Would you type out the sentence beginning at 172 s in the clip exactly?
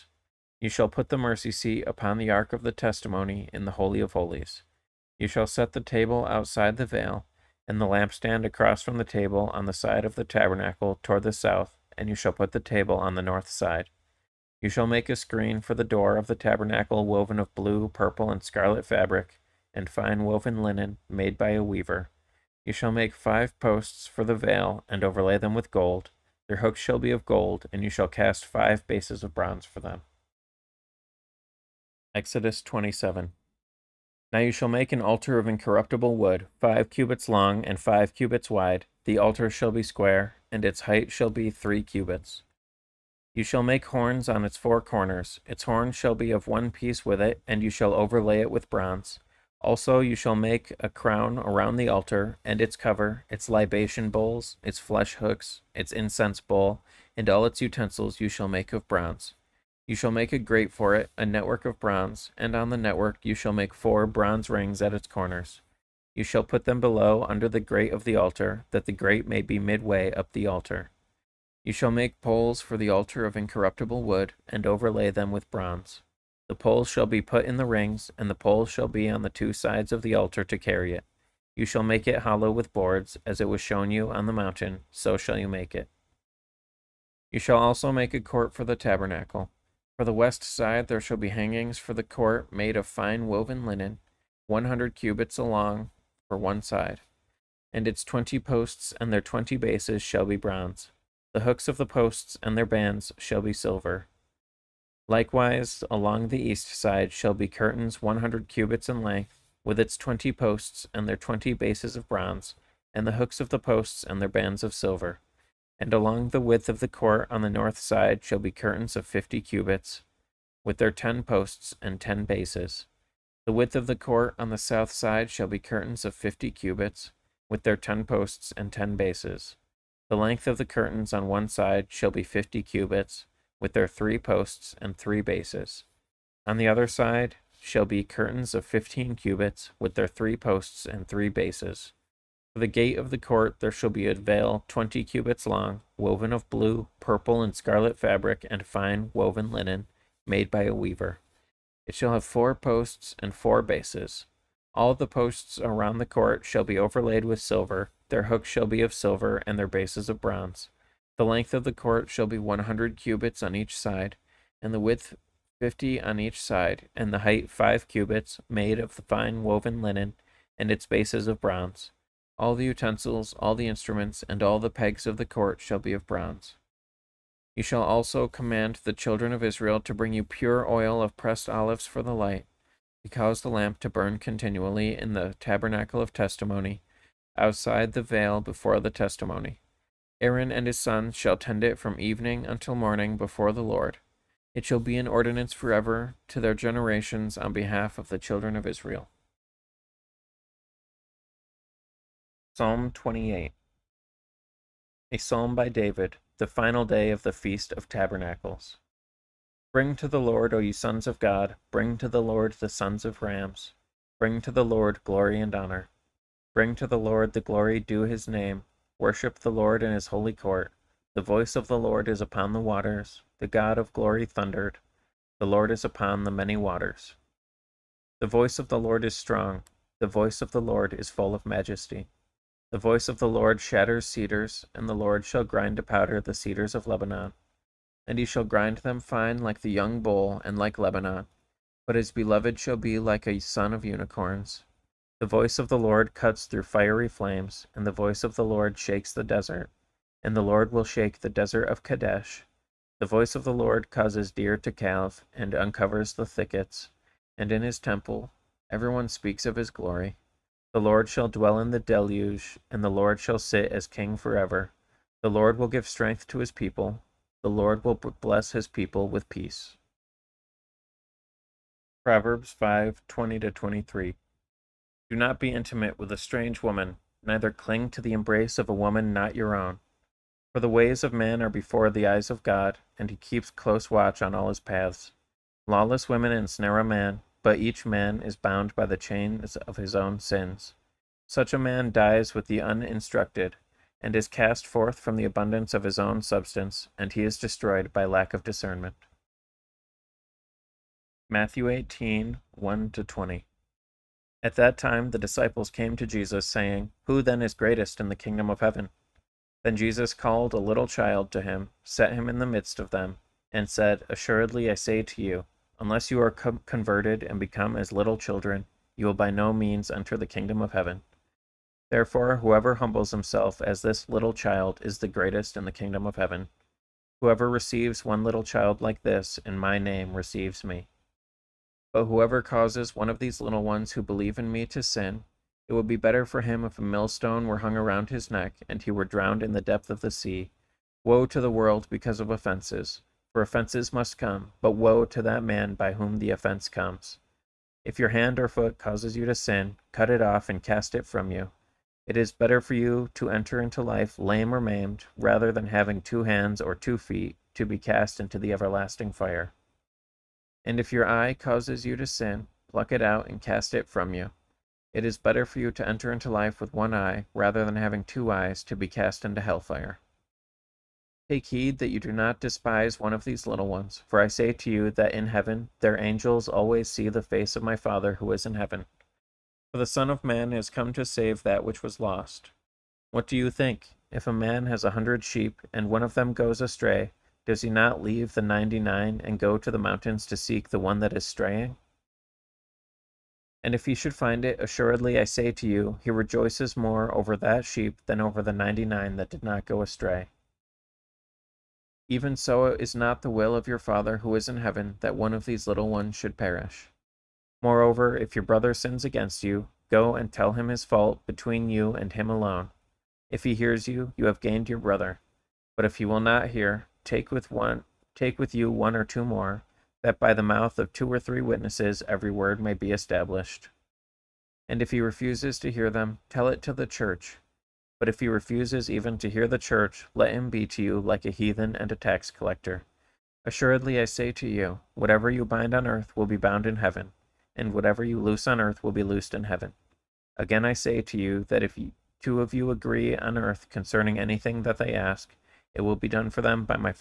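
All the utensils, all the instruments, and all the pegs of the court shall be of bronze.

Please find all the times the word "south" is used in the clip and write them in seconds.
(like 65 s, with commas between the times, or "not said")
11 s, 124 s.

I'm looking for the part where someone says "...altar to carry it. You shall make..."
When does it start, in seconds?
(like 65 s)
80 s.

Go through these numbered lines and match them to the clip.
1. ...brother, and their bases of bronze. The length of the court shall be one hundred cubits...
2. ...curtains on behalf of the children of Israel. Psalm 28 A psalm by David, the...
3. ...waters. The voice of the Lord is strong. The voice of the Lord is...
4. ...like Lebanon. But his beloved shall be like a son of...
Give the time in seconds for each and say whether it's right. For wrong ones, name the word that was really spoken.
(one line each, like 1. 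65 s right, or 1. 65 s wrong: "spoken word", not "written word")
1. 158 s wrong: "silver", not "brother"
2. 196 s wrong: "generations", not "curtains"
3. 226 s right
4. 240 s right.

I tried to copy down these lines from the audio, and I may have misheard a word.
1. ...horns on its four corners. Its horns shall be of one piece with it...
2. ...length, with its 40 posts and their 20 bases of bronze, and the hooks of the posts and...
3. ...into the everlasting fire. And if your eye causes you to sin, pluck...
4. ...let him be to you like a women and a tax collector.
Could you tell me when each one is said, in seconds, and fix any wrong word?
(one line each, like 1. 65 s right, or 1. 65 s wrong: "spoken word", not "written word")
1. 43 s right
2. 109 s wrong: "20", not "40"
3. 358 s right
4. 430 s wrong: "heathen", not "women".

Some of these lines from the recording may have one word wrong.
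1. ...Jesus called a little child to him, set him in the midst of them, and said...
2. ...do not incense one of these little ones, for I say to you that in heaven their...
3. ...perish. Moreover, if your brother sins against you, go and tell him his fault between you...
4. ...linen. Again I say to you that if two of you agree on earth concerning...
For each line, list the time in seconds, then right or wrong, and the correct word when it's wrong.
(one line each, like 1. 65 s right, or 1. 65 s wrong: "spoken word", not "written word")
1. 309 s right
2. 371 s wrong: "despise", not "incense"
3. 406 s right
4. 439 s wrong: "heaven", not "linen".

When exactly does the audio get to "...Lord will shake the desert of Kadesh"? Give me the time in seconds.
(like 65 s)
250 s.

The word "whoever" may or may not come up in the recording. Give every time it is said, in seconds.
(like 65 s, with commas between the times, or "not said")
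322 s, 327 s, 332 s.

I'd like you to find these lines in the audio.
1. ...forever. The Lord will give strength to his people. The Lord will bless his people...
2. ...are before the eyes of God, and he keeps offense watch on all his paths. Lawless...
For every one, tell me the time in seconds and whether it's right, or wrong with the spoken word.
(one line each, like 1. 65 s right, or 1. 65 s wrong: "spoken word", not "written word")
1. 264 s right
2. 281 s wrong: "close", not "offense".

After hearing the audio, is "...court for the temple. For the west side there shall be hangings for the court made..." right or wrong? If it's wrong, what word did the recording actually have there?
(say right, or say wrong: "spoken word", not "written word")
wrong: "tabernacle", not "temple".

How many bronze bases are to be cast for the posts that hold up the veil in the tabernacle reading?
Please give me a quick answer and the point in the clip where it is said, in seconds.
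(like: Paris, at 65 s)
5, at 28 s.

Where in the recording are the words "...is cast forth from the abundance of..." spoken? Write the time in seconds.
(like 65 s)
294 s.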